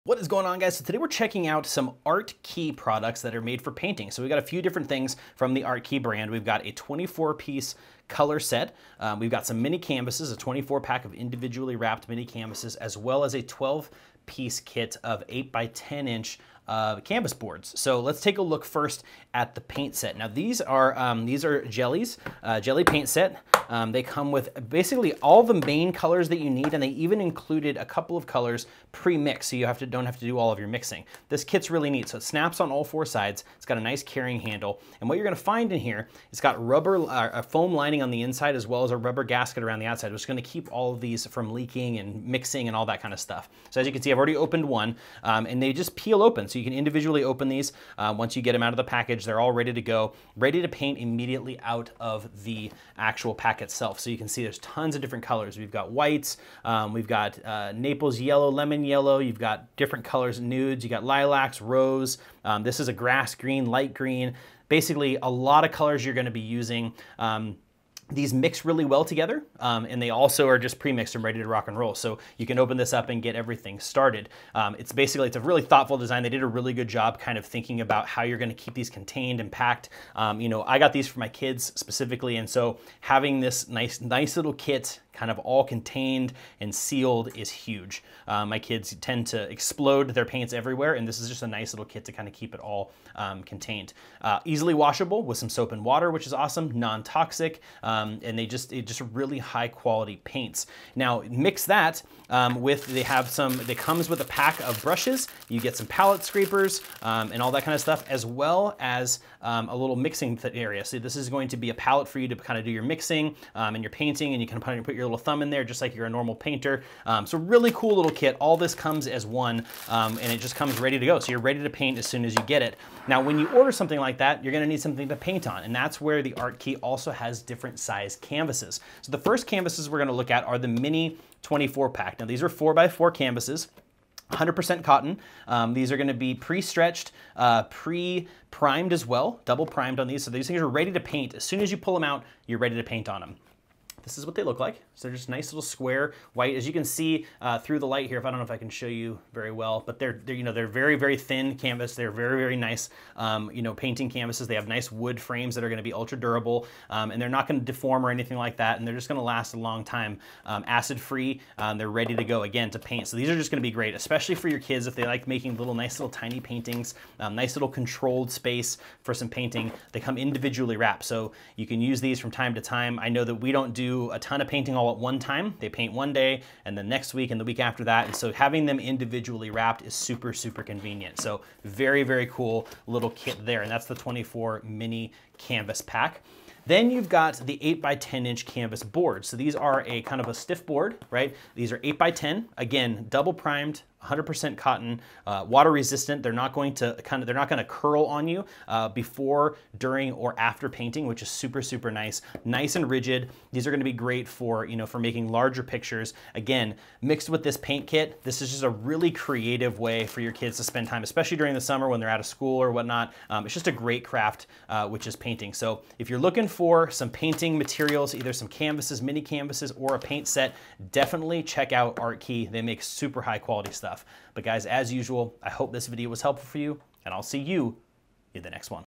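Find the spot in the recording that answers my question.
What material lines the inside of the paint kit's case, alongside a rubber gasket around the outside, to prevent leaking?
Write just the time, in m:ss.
0:37.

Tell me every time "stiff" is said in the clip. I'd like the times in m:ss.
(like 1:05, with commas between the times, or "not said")
3:10.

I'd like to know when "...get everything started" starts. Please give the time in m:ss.
1:13.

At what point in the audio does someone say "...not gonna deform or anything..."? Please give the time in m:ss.
2:37.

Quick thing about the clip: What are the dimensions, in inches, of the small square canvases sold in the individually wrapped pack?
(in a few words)
4 by 4.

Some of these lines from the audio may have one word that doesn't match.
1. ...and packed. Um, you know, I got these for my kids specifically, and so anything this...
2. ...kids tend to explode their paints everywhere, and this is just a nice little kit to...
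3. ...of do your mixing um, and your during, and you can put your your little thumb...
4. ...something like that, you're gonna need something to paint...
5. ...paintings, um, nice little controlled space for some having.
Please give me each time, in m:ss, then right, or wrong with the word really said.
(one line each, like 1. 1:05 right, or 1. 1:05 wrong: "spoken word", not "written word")
1. 1:19 wrong: "having", not "anything"
2. 1:28 right
3. 1:52 wrong: "painting", not "during"
4. 2:03 right
5. 2:46 wrong: "painting", not "having".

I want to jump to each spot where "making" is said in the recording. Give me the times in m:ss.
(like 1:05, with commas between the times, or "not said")
2:45, 3:24.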